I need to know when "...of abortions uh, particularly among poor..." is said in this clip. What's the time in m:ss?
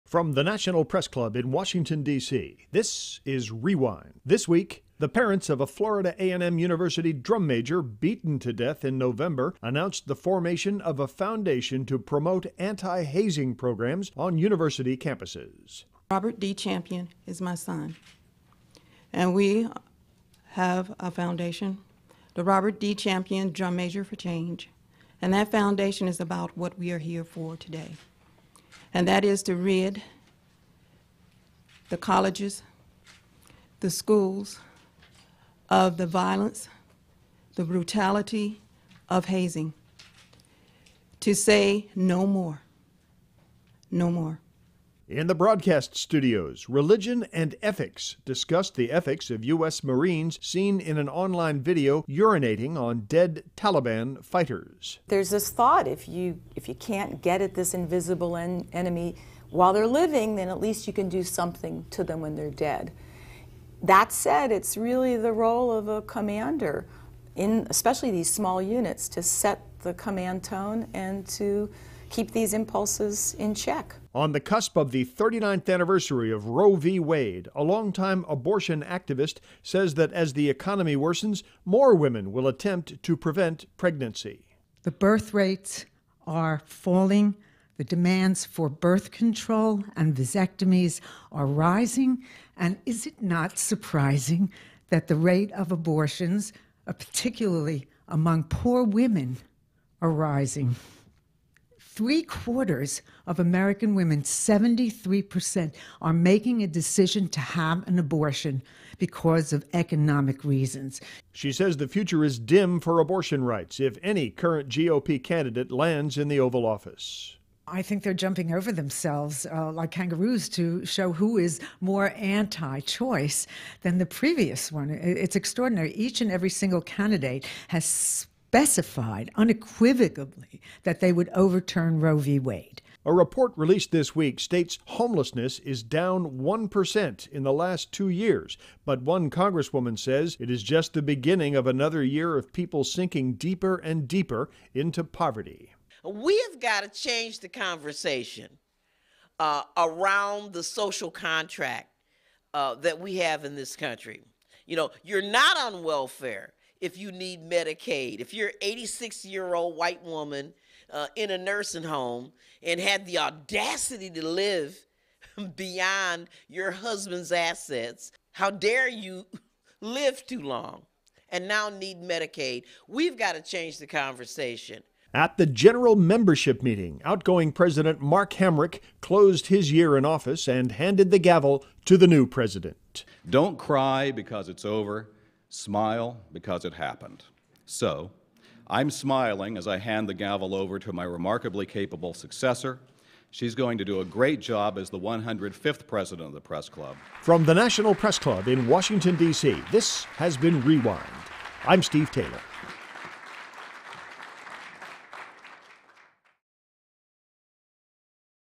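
1:35.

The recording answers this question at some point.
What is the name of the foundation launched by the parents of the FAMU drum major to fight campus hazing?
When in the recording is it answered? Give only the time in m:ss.
0:22.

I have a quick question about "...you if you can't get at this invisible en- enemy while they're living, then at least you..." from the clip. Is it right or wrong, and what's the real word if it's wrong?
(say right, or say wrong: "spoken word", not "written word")
right.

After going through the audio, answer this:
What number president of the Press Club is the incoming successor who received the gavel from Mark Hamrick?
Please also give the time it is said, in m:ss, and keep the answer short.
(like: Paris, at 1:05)
105th, at 3:14.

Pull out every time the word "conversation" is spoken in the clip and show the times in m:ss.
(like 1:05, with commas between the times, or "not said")
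2:27, 2:53.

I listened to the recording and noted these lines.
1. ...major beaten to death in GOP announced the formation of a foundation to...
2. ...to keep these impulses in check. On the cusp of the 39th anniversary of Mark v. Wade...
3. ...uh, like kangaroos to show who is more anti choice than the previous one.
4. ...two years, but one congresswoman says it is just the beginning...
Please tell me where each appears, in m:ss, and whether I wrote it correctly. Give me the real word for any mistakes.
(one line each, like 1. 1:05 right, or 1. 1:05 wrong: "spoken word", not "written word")
1. 0:07 wrong: "November", not "GOP"
2. 1:11 wrong: "Roe", not "Mark"
3. 1:59 right
4. 2:17 right.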